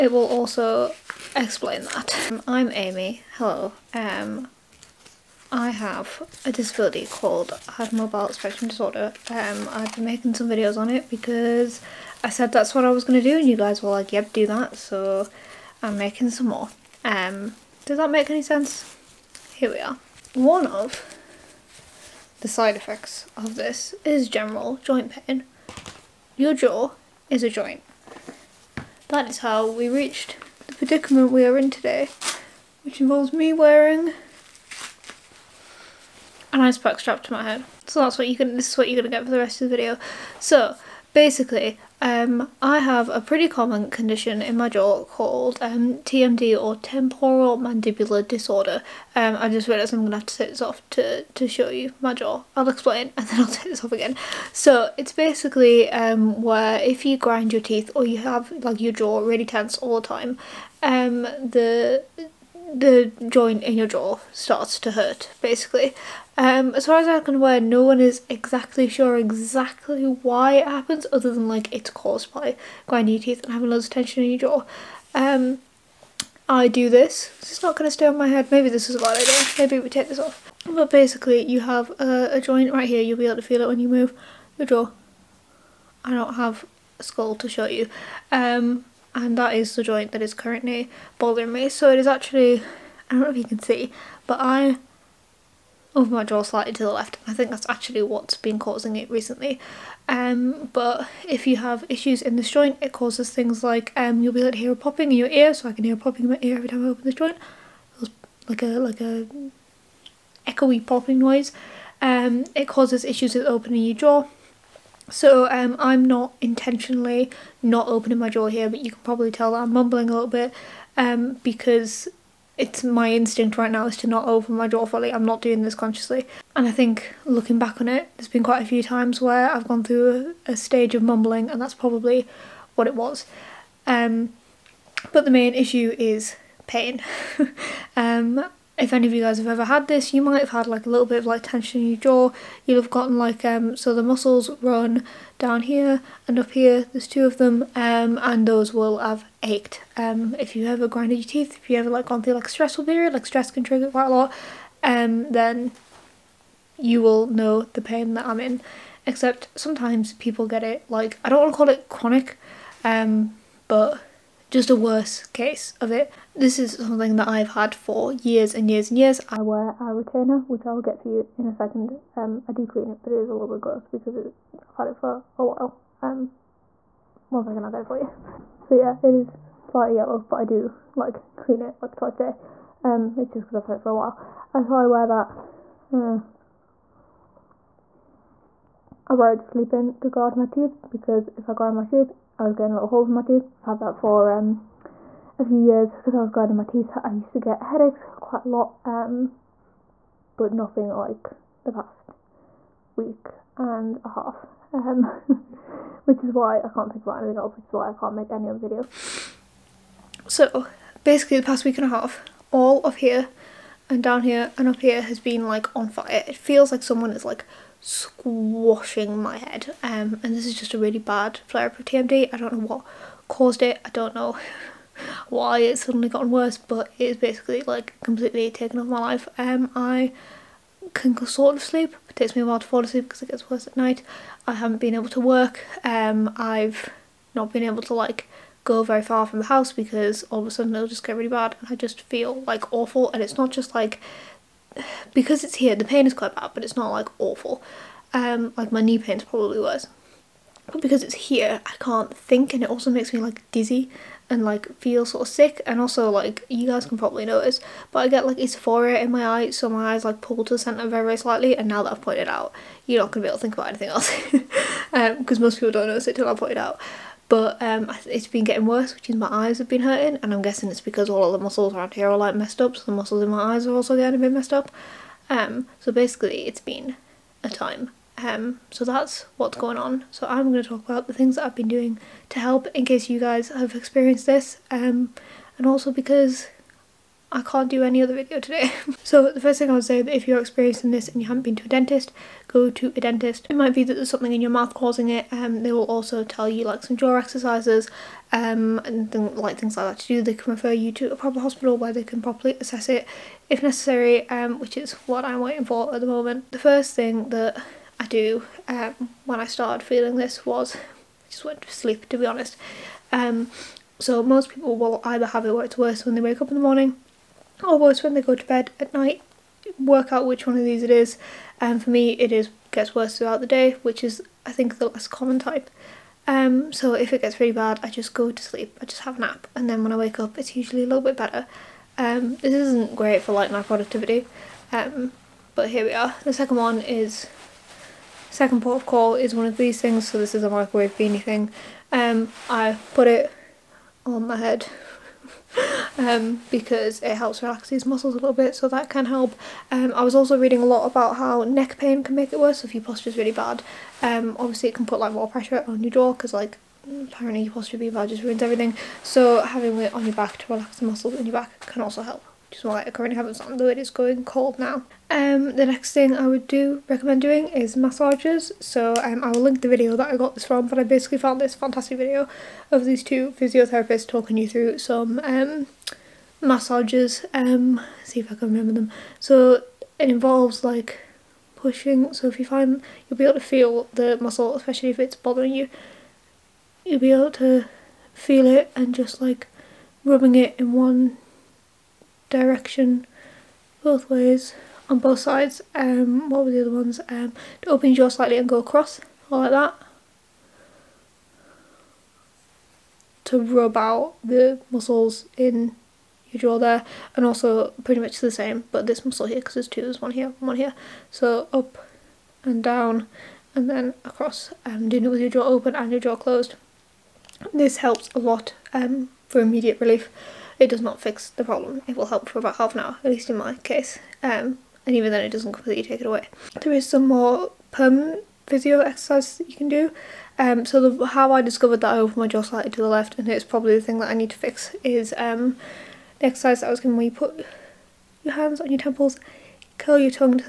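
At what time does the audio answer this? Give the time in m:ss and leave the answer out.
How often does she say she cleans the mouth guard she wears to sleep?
3:01.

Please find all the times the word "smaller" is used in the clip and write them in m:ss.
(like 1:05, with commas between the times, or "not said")
not said.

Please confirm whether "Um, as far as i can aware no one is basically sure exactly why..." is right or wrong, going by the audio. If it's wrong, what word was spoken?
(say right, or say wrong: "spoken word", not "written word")
wrong: "exactly", not "basically".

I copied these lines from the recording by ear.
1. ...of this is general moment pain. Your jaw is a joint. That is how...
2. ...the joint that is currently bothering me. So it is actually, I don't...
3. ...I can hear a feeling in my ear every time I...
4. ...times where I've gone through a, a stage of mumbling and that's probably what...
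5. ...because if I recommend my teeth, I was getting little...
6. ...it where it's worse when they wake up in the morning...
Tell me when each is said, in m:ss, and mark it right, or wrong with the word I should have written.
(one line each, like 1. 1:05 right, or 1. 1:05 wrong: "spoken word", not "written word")
1. 0:23 wrong: "joint", not "moment"
2. 1:29 right
3. 1:45 wrong: "popping", not "feeling"
4. 2:08 right
5. 3:10 wrong: "grind", not "recommend"
6. 5:15 right.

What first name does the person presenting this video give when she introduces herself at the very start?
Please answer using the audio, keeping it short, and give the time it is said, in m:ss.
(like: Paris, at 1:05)
Amy, at 0:02.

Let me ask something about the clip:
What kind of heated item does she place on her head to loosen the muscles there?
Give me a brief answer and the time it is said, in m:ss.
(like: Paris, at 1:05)
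Microwave beanie, at 5:40.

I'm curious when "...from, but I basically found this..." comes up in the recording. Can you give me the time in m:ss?
6:10.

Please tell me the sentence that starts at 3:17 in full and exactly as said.
I used to get headaches quite a lot, um, but nothing like the past week and a half.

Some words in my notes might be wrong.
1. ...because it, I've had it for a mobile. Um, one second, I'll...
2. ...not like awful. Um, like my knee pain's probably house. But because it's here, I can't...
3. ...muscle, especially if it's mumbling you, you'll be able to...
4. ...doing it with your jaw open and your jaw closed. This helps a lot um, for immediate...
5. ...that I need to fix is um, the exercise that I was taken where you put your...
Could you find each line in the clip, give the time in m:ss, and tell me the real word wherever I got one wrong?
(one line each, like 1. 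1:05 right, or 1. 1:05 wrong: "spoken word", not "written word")
1. 2:53 wrong: "while", not "mobile"
2. 4:06 wrong: "worse", not "house"
3. 6:24 wrong: "bothering", not "mumbling"
4. 6:54 right
5. 7:13 wrong: "given", not "taken".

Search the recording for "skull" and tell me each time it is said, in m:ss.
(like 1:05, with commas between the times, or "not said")
1:27.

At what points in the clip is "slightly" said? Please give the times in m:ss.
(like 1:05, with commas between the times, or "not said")
1:36, 2:59, 4:21, 6:38, 7:12.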